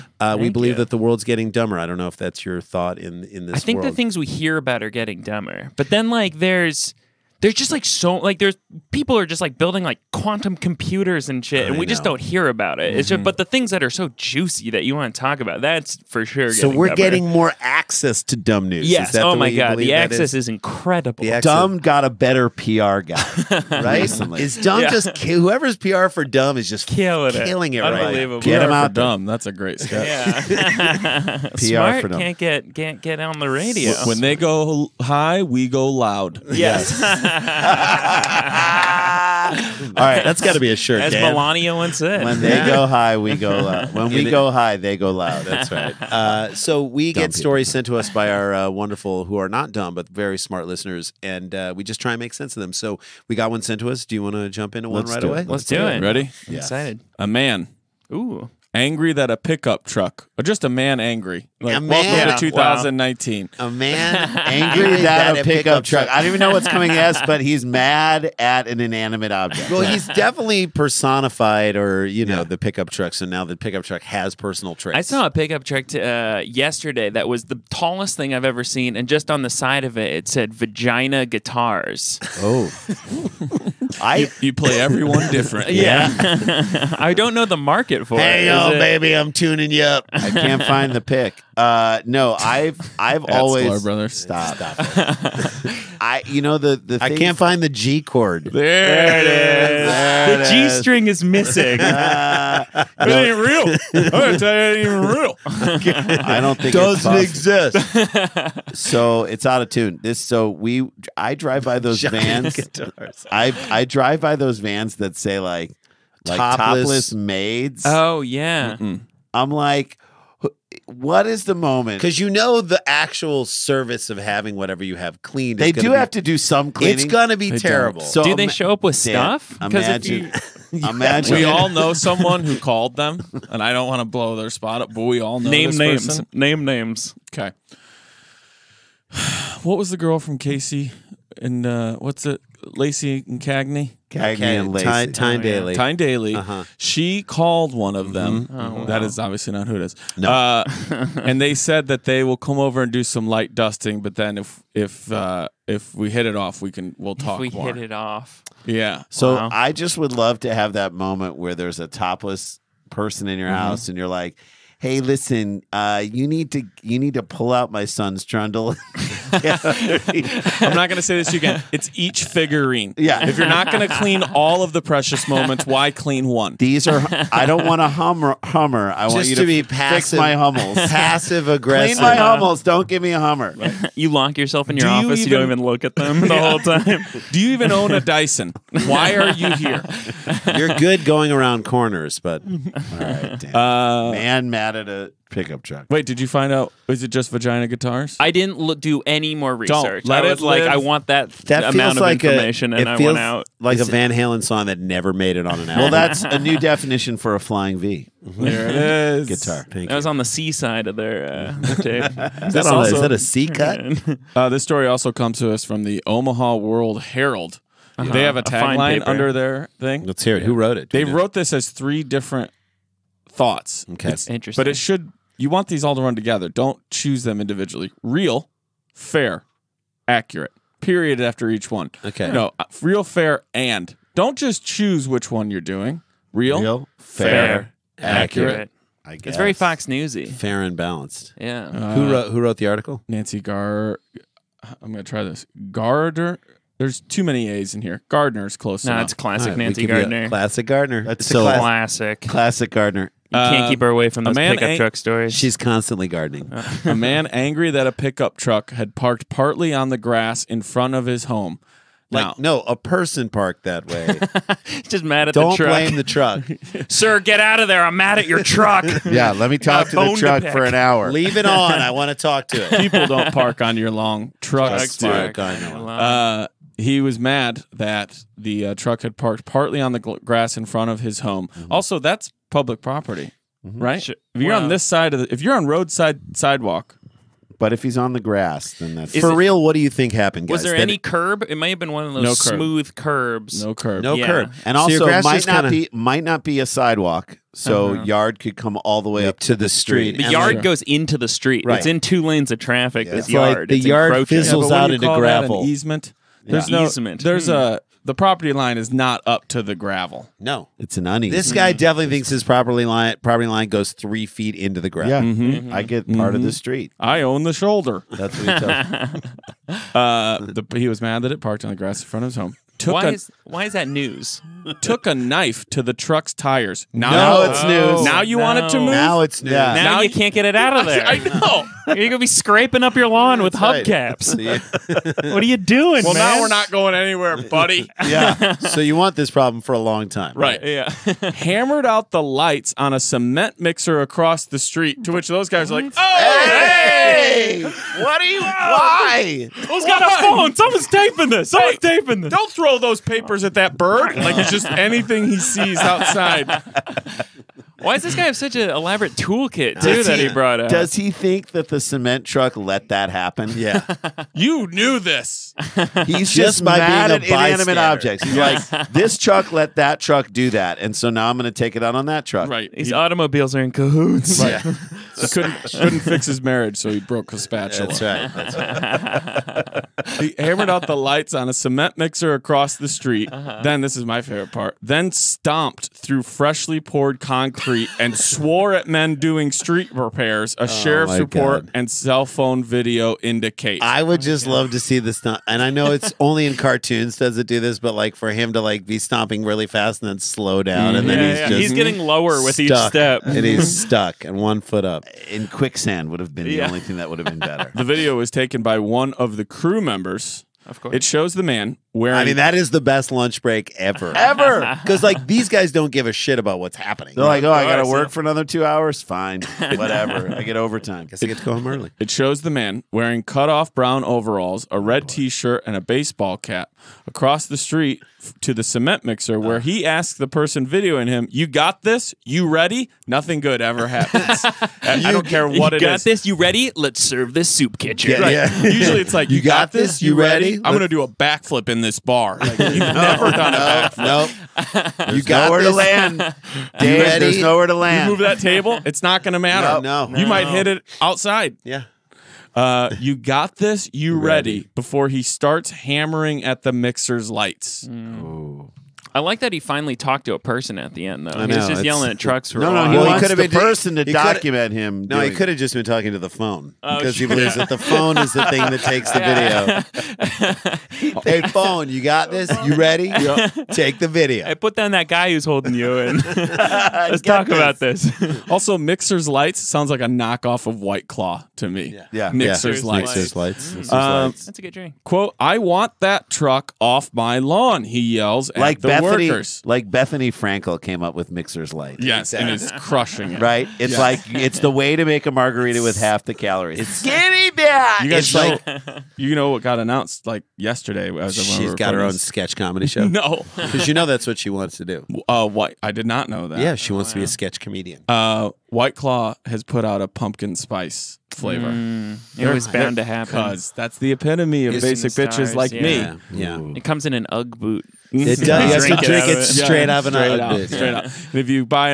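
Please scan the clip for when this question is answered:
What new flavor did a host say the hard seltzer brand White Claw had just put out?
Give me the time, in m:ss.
8:30.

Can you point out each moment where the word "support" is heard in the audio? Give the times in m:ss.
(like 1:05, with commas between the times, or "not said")
not said.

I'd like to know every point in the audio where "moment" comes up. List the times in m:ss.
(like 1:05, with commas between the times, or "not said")
2:01, 2:40, 2:55.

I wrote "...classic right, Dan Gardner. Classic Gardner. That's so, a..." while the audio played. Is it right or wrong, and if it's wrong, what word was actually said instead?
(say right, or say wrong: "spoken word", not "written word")
wrong: "Nancy", not "Dan".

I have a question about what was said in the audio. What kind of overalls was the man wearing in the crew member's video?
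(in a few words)
Cut off brown.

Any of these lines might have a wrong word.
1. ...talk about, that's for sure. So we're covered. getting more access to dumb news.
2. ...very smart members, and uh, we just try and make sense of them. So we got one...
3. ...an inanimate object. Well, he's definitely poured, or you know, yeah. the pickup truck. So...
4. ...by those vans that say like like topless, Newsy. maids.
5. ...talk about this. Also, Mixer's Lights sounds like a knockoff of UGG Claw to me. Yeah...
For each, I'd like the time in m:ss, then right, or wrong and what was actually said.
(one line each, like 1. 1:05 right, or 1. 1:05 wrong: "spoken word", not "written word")
1. 0:15 right
2. 0:50 wrong: "listeners", not "members"
3. 1:08 wrong: "personified", not "poured"
4. 1:54 wrong: "Topless", not "Newsy"
5. 7:57 wrong: "White", not "UGG".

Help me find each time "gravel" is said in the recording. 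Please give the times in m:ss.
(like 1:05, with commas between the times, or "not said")
5:05, 5:09, 5:14.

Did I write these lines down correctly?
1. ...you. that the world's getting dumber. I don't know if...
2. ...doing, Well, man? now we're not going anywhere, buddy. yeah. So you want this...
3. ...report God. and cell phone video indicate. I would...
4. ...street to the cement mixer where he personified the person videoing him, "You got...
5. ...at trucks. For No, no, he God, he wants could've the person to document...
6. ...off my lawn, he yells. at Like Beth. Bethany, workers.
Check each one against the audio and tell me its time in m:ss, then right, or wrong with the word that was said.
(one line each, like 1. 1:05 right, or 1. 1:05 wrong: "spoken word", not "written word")
1. 0:00 right
2. 5:35 right
3. 6:31 right
4. 7:07 wrong: "asked", not "personified"
5. 7:42 wrong: "Well", not "God"
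6. 8:06 right.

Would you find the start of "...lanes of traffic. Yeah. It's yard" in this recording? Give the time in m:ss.
5:02.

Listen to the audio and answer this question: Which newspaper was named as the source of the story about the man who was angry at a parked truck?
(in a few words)
Omaha World Herald.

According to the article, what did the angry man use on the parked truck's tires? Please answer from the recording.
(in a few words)
Took a knife.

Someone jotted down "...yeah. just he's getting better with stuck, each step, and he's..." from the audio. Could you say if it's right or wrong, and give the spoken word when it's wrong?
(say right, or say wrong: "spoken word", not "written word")
wrong: "lower", not "better".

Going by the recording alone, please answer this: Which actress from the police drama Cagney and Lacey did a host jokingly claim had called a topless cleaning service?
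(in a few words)
Tyne Daly.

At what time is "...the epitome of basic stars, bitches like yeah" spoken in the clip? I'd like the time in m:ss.
8:33.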